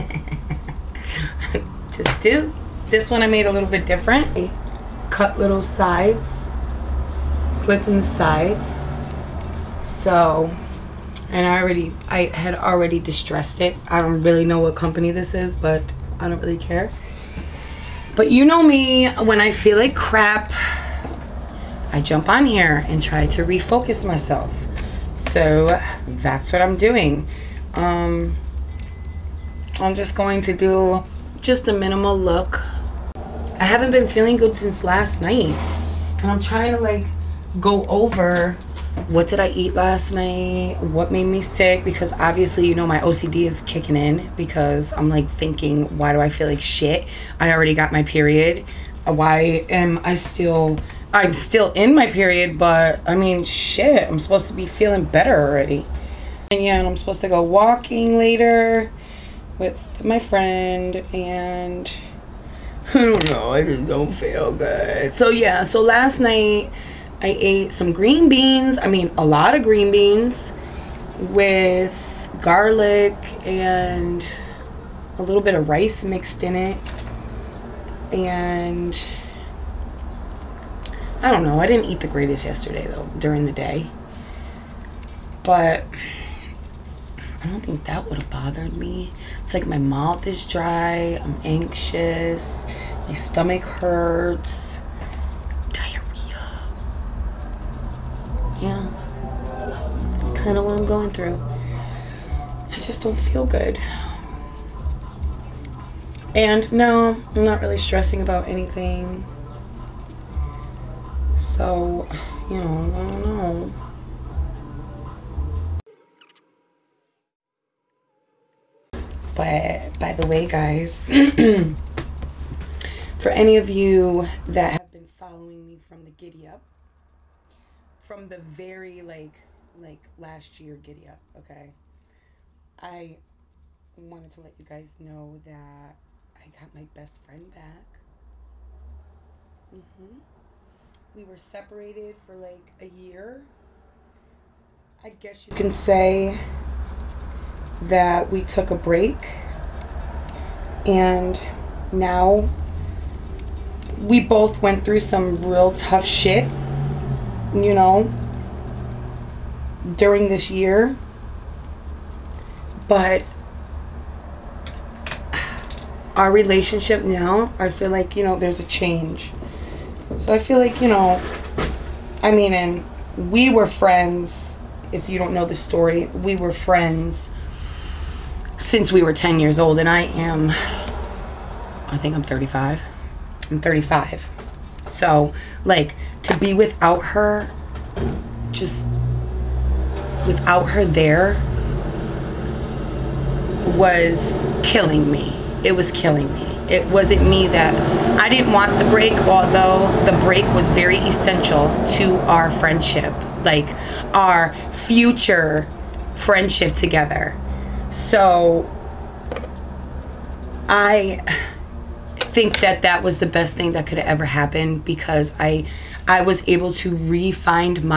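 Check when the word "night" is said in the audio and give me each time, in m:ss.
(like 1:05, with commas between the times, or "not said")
0:35, 0:40, 1:06.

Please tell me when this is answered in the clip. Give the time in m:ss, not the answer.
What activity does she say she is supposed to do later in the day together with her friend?
0:57.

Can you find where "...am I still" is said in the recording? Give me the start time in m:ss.
0:49.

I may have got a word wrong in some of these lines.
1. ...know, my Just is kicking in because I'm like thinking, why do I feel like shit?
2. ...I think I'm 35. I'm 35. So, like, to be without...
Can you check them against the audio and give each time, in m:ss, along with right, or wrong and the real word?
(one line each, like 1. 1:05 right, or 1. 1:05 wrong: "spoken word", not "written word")
1. 0:42 wrong: "OCD", not "Just"
2. 3:00 right.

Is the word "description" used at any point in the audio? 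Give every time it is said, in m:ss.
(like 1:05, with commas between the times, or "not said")
not said.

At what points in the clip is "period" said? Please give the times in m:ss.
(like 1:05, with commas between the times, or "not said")
0:48, 0:52.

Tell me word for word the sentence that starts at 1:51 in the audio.
So, you know, I don't know.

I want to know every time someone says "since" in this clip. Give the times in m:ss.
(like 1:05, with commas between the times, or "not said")
0:34, 2:58.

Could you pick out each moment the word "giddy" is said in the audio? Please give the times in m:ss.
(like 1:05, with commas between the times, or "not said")
2:06, 2:10.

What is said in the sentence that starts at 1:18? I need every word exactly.
And I don't know, I didn't eat the greatest yesterday though, during the day.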